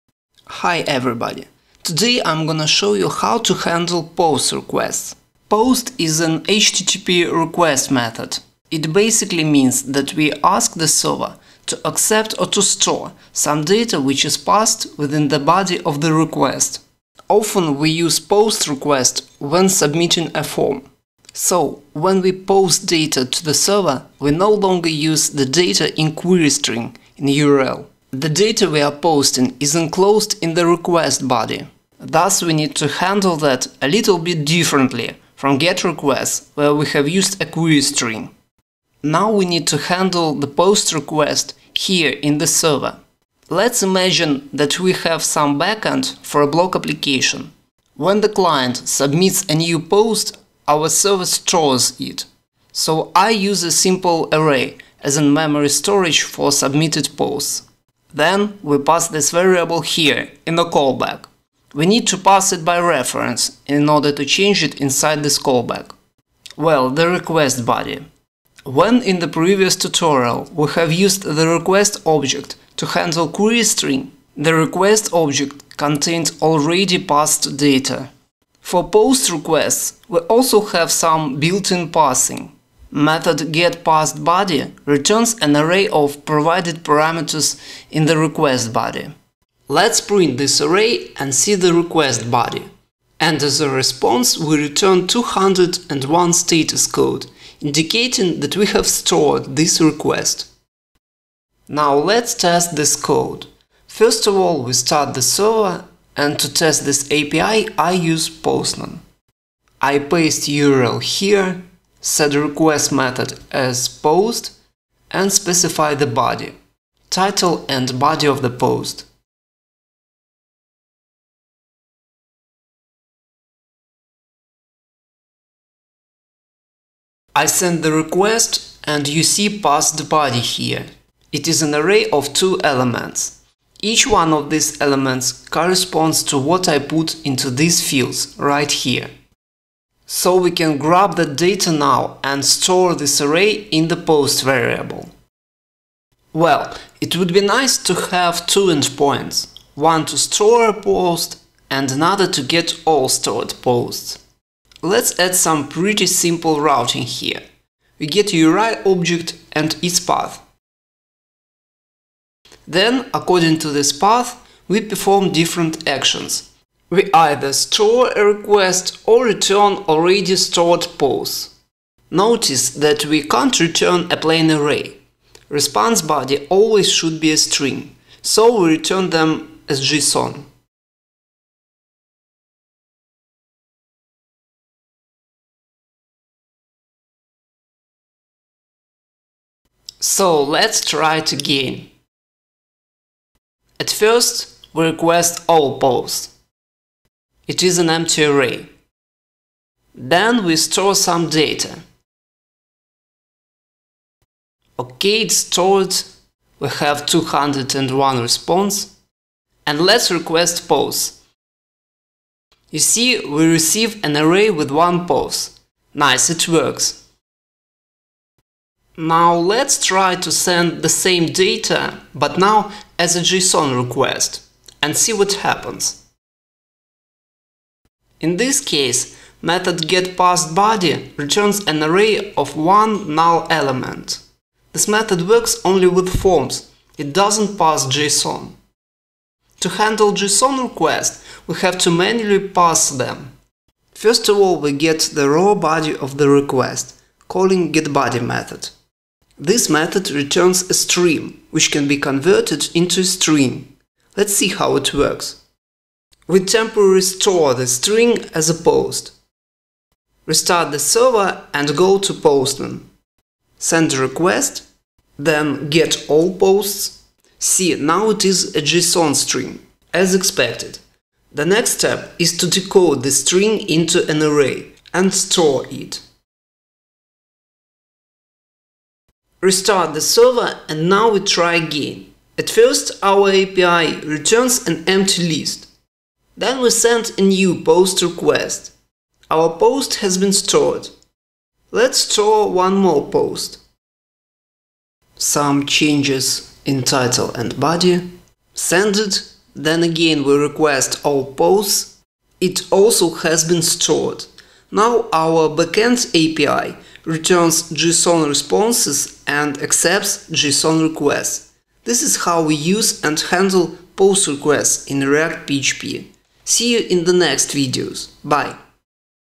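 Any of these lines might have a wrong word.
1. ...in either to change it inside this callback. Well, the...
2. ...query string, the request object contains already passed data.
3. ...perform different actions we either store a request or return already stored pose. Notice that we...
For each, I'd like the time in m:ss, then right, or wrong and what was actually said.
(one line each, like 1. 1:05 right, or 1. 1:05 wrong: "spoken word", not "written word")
1. 1:03 wrong: "order", not "either"
2. 1:13 right
3. 2:44 right.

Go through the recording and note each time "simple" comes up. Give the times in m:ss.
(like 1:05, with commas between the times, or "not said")
0:53, 2:36.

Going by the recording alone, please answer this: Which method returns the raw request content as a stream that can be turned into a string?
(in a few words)
getBody.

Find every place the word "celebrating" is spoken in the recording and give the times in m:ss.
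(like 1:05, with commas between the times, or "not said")
not said.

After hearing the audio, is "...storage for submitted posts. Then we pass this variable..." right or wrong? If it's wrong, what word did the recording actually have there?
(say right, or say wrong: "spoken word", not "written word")
right.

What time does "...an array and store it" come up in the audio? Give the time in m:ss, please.
4:34.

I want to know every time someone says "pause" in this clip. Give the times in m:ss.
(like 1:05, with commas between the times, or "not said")
3:30, 3:35.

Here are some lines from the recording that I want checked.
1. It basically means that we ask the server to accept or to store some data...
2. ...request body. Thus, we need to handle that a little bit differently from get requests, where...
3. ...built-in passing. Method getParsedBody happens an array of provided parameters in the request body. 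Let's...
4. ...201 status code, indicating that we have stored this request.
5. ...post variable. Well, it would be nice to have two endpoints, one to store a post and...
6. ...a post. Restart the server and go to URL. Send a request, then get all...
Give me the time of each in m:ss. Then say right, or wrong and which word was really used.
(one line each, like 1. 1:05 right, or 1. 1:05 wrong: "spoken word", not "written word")
1. 0:08 right
2. 0:30 right
3. 1:21 wrong: "returns", not "happens"
4. 1:35 right
5. 2:23 right
6. 4:18 wrong: "Postman", not "URL".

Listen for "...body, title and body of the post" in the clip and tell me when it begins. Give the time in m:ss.
1:56.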